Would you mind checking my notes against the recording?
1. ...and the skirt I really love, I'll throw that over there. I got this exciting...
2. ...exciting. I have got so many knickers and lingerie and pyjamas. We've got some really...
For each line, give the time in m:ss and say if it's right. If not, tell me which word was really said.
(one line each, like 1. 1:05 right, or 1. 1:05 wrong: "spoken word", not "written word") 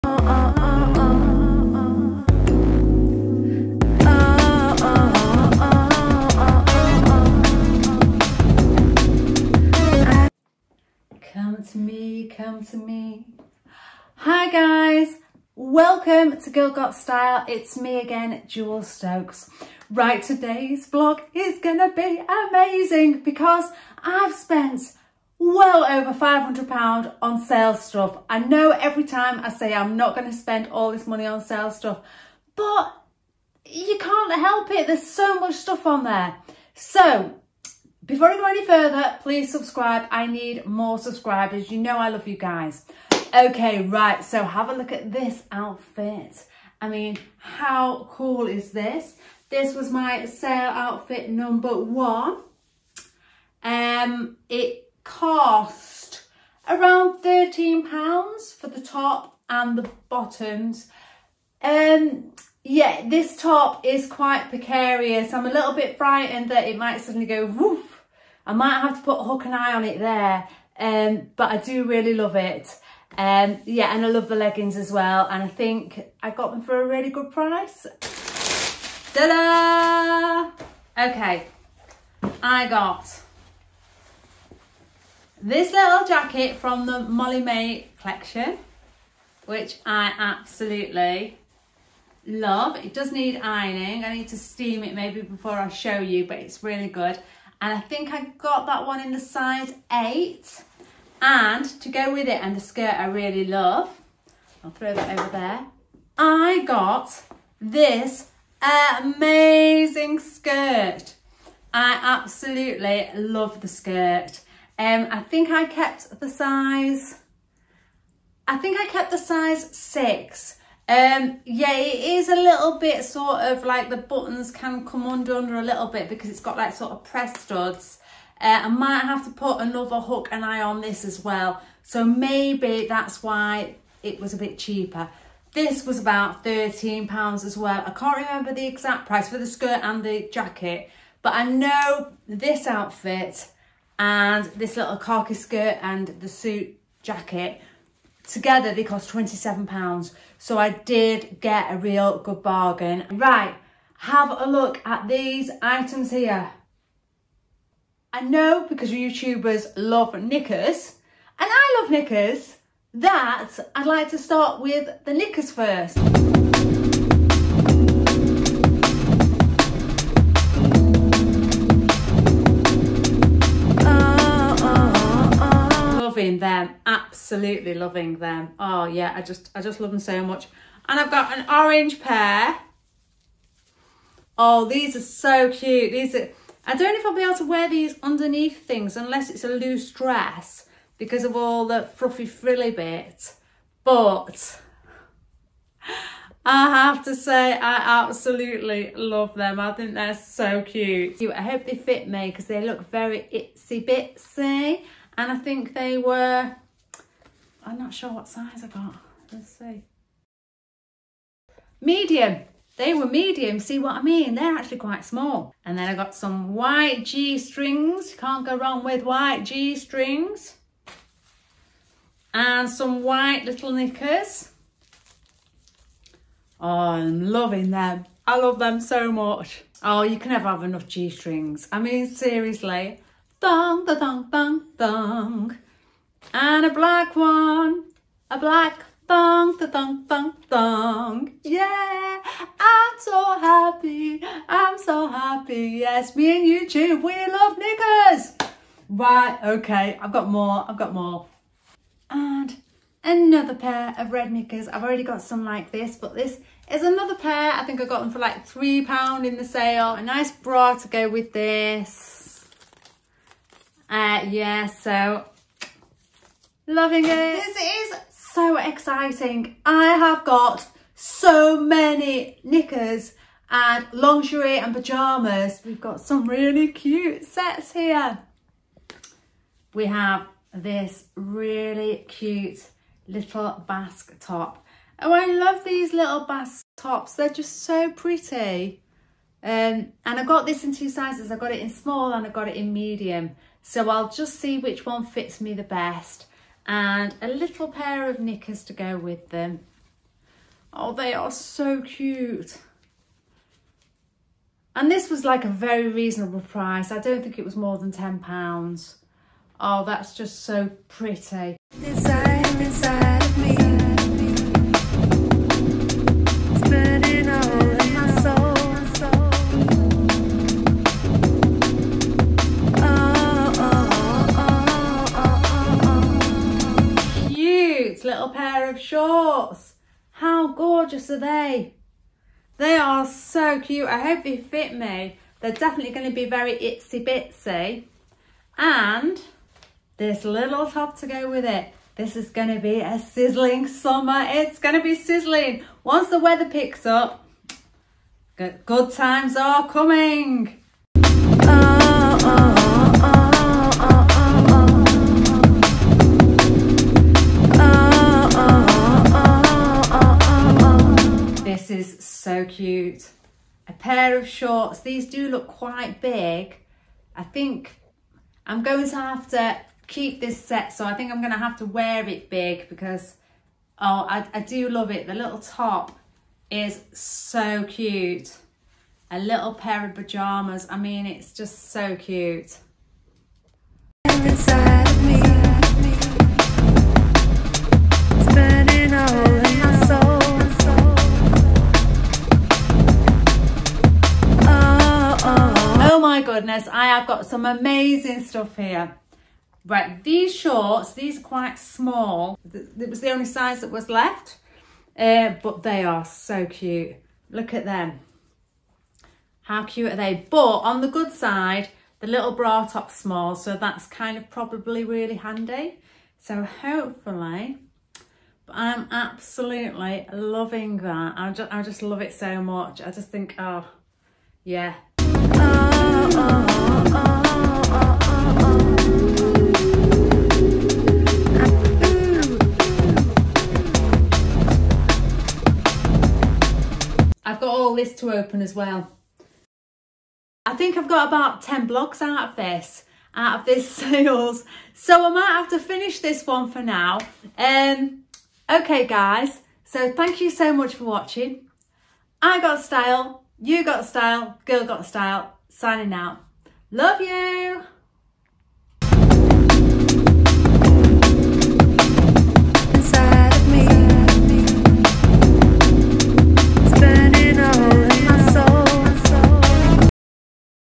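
1. 1:42 wrong: "amazing", not "exciting"
2. 4:28 right.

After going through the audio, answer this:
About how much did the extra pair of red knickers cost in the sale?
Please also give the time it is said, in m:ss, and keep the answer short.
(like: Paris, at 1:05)
£3, at 4:18.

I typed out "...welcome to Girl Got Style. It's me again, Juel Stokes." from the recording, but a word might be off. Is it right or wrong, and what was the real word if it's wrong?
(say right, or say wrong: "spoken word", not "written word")
right.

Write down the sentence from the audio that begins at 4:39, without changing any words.
We have this really cute little basque top.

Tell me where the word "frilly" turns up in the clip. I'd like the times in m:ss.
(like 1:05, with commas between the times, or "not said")
3:12.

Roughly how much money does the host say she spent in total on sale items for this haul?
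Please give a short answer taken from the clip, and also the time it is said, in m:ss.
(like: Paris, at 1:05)
£500, at 0:26.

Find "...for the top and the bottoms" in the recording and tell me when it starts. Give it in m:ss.
0:58.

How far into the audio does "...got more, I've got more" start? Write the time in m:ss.
4:10.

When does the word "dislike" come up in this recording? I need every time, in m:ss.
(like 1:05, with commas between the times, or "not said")
not said.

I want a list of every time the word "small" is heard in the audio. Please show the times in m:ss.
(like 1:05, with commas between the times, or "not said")
3:35, 4:51, 6:41, 6:52.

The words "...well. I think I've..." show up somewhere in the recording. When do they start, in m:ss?
7:18.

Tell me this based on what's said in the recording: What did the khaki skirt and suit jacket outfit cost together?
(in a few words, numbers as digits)
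£27.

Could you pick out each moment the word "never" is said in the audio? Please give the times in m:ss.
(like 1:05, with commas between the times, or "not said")
3:50.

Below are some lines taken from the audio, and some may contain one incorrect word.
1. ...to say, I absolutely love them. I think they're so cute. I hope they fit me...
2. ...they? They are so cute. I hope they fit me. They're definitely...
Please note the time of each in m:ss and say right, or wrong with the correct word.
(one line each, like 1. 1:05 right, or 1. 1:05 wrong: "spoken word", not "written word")
1. 3:17 right
2. 5:31 right.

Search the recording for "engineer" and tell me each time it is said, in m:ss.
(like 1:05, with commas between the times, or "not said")
not said.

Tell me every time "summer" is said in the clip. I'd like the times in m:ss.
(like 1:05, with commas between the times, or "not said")
5:43.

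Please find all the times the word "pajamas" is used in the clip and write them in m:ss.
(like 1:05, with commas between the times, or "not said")
6:19.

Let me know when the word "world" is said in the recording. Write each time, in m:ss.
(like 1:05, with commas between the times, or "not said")
not said.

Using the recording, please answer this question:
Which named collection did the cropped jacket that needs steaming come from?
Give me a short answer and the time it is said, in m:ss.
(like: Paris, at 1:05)
Molly Mae collection, at 1:26.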